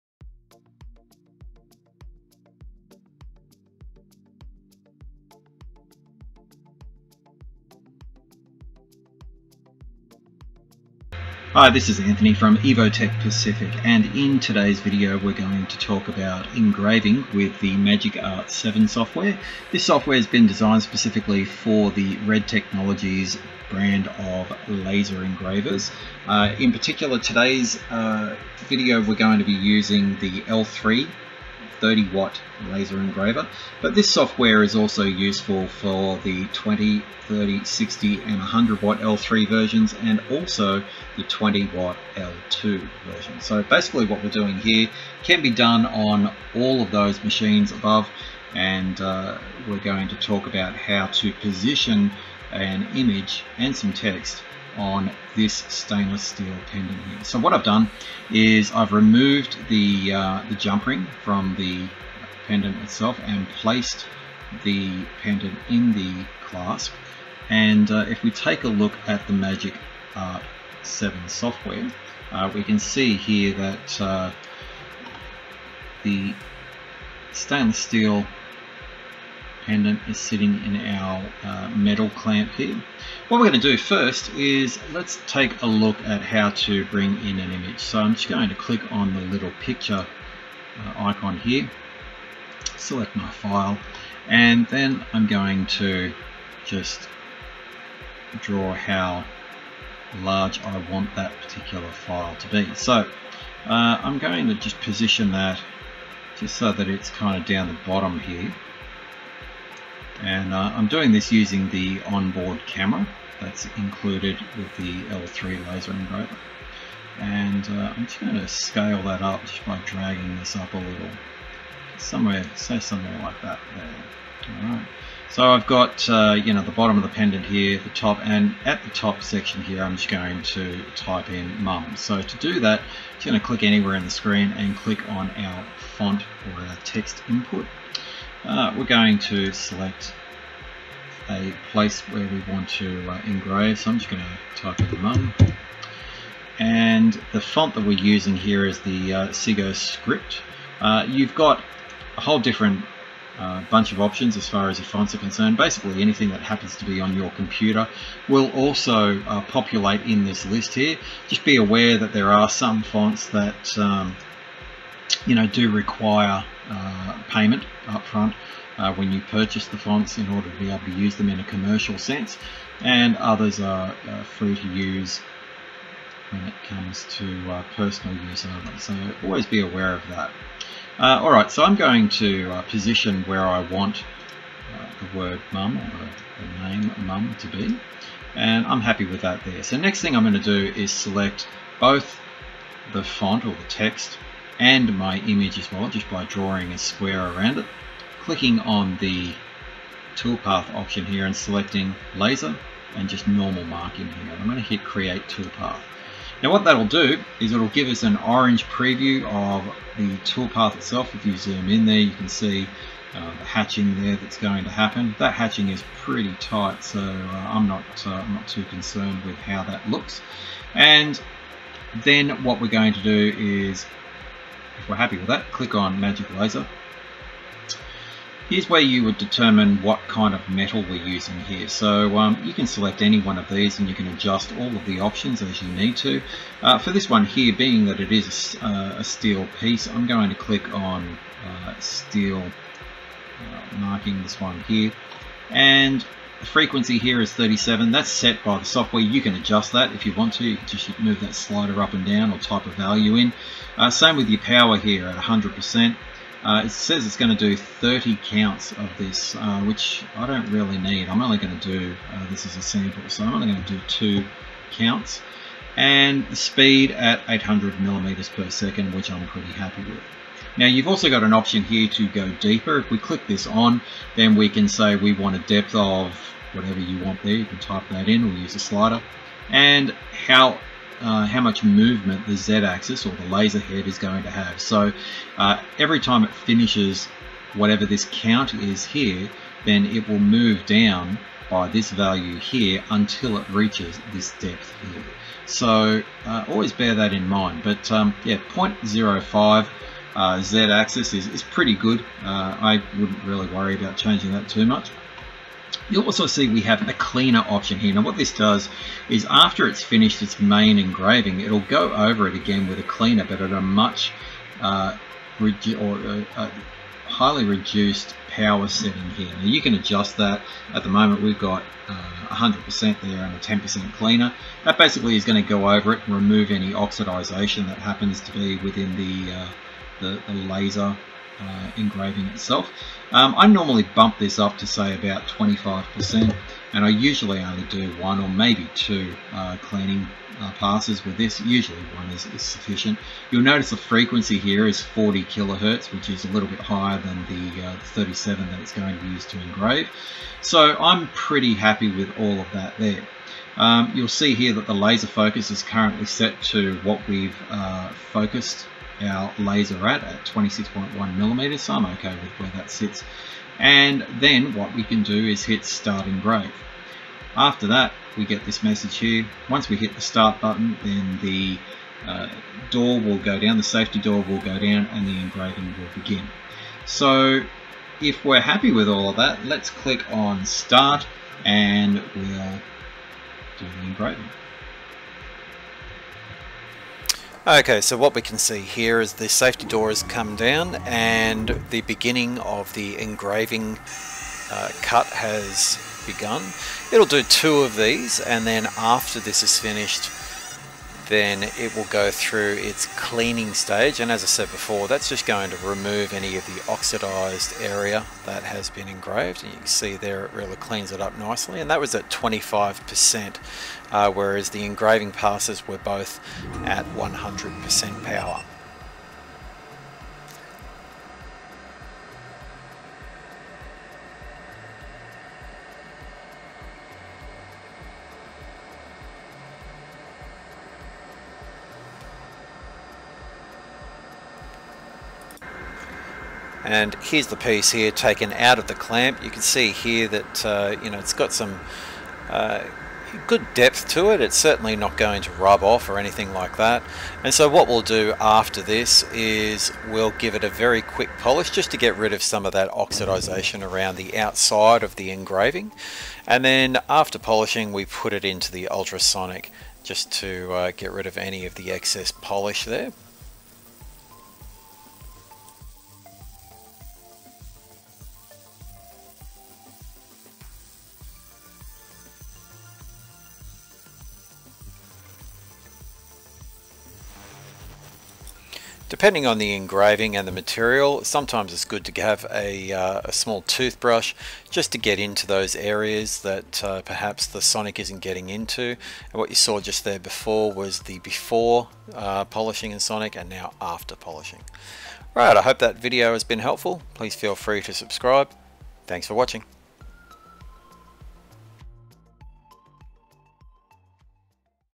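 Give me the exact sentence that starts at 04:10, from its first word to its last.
You can just move that slider up and down or type a value in.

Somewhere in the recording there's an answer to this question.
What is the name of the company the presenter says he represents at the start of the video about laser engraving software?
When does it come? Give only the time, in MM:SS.
00:12.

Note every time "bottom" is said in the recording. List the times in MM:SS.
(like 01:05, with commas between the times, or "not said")
01:47, 02:06.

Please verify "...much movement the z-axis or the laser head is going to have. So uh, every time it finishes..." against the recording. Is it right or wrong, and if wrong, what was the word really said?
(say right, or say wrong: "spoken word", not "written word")
right.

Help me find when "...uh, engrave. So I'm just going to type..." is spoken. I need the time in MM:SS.
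02:23.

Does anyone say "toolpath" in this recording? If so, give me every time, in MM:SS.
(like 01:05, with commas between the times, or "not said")
03:20, 03:25, 03:30.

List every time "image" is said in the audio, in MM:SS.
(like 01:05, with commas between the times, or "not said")
00:52, 01:27, 03:15.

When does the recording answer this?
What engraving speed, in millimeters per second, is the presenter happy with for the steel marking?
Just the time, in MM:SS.
04:27.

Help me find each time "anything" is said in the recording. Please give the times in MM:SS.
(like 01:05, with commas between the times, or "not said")
02:36, 07:25.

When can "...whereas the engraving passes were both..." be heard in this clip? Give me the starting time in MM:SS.
06:54.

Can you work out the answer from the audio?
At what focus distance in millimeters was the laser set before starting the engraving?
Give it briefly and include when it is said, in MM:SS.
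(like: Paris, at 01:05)
26.1 mm, at 06:00.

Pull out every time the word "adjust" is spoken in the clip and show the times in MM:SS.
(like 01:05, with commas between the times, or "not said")
03:54, 04:09, 05:19.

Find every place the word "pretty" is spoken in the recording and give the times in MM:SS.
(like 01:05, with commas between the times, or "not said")
03:35, 04:29, 05:01, 05:51.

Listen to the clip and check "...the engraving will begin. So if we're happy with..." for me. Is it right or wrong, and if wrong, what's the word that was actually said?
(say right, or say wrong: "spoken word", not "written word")
right.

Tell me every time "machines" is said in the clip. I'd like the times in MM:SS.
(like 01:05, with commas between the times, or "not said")
00:47.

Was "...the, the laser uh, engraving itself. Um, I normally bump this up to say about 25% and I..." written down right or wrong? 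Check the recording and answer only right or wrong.
right.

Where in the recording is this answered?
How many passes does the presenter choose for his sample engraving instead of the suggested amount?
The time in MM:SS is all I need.
04:23.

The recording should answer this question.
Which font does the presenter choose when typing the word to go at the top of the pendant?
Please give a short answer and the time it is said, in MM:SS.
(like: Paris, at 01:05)
Segoe Script, at 02:29.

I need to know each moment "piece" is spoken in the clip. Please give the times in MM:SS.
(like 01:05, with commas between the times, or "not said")
03:59, 07:17.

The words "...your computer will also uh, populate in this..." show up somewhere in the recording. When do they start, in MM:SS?
02:37.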